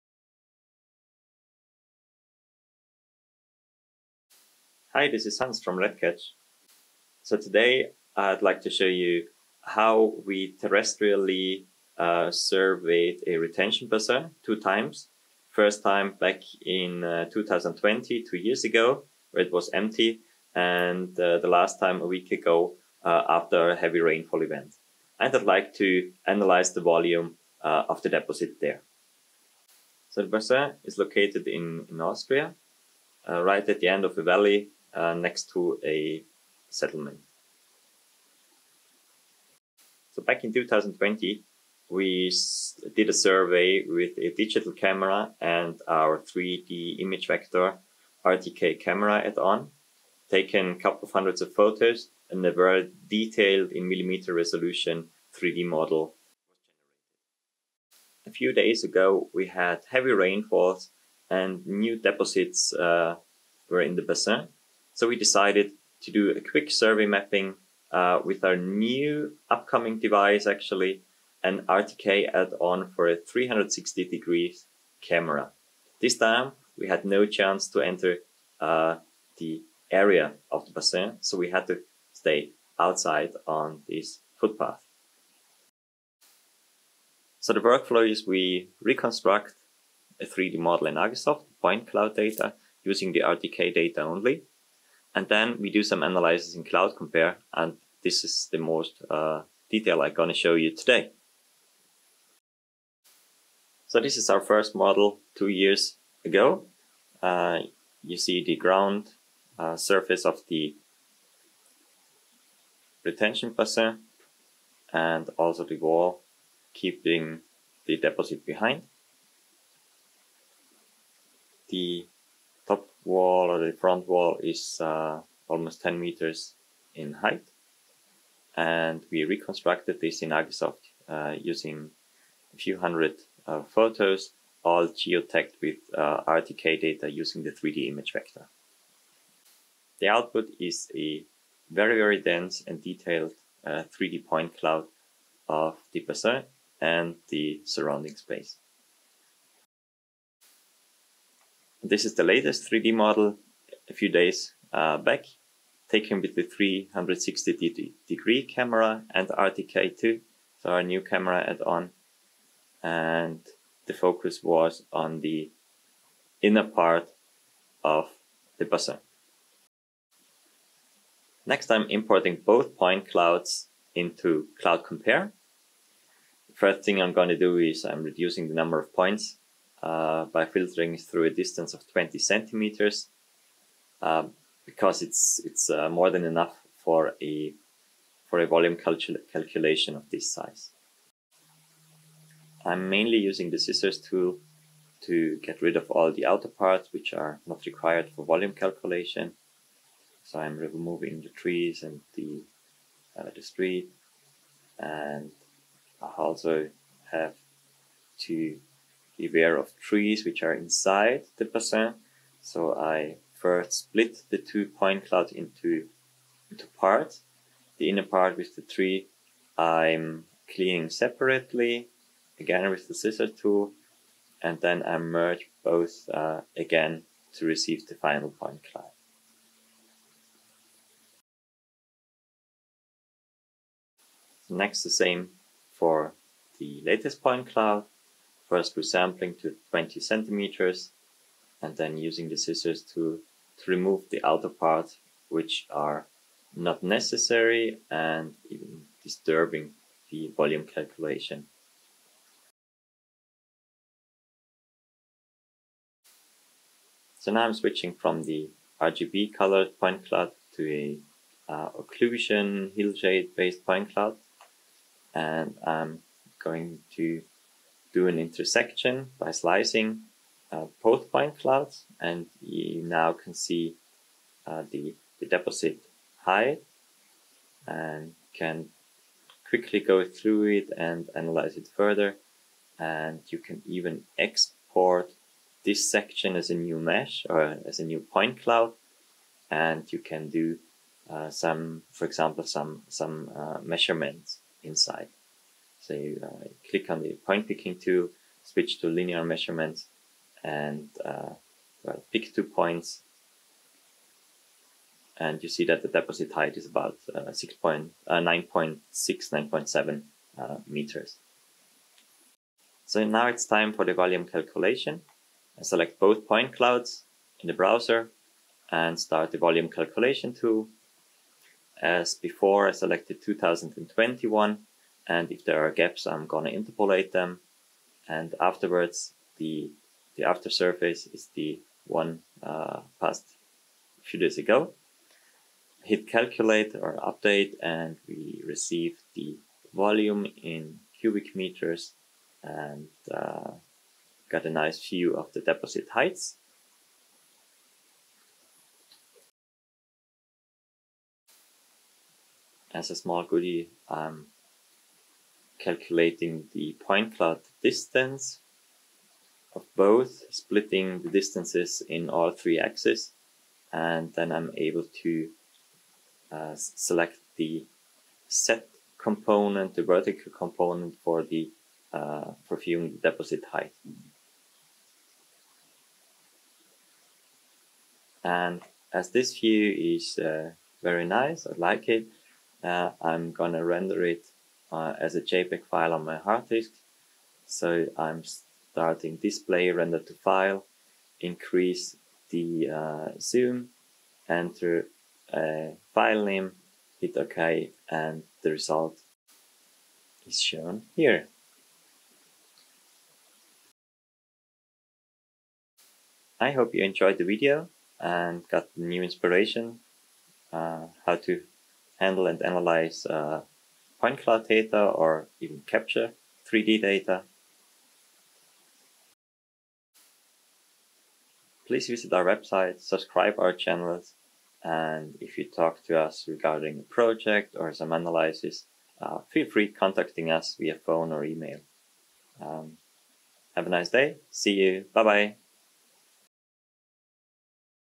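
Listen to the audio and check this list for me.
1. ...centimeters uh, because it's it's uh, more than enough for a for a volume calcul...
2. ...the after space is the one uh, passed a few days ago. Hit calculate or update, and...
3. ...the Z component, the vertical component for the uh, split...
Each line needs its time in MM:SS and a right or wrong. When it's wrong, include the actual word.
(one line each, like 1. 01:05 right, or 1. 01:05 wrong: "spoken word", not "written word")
1. 03:02 right
2. 05:30 wrong: "surface", not "space"
3. 06:07 wrong: "deposit", not "split".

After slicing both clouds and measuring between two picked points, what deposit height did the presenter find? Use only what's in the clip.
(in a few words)
9.6 to 9.7 meters.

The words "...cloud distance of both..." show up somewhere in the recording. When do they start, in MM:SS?
05:57.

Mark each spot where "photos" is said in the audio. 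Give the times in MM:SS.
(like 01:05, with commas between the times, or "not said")
00:51, 02:13.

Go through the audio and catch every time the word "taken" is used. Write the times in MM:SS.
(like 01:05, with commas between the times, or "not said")
00:50, 02:35.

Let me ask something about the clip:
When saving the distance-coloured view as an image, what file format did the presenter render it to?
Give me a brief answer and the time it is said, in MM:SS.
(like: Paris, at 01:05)
JPEG, at 06:25.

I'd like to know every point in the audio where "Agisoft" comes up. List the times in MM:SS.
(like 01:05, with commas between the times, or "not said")
01:30, 02:10.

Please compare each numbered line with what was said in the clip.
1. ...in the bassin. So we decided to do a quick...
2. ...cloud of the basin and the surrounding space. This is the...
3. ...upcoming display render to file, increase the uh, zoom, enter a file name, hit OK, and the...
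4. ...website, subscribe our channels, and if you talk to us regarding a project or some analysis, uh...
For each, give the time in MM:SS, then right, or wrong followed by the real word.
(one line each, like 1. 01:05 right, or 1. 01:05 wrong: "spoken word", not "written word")
1. 01:03 right
2. 02:24 right
3. 06:28 wrong: "starting", not "upcoming"
4. 07:02 right.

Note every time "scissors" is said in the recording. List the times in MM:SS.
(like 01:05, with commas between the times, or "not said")
03:13, 03:42, 04:02.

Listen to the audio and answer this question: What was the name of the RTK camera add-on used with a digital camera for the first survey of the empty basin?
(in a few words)
3D ImageVector.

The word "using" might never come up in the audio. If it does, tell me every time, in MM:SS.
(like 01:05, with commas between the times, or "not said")
01:32, 02:11, 02:17, 03:13, 04:01.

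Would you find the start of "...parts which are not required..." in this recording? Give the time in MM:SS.
03:16.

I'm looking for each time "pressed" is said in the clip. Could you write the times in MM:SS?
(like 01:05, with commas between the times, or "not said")
not said.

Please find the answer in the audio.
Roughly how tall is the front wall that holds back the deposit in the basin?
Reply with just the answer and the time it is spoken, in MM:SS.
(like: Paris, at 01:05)
almost 10 meters, at 02:05.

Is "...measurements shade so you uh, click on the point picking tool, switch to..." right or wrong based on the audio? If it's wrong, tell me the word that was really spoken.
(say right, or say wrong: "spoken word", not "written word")
wrong: "inside", not "shade".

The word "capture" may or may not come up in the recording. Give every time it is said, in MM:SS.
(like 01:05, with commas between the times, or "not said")
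06:55.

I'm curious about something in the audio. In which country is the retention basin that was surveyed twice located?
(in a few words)
Austria.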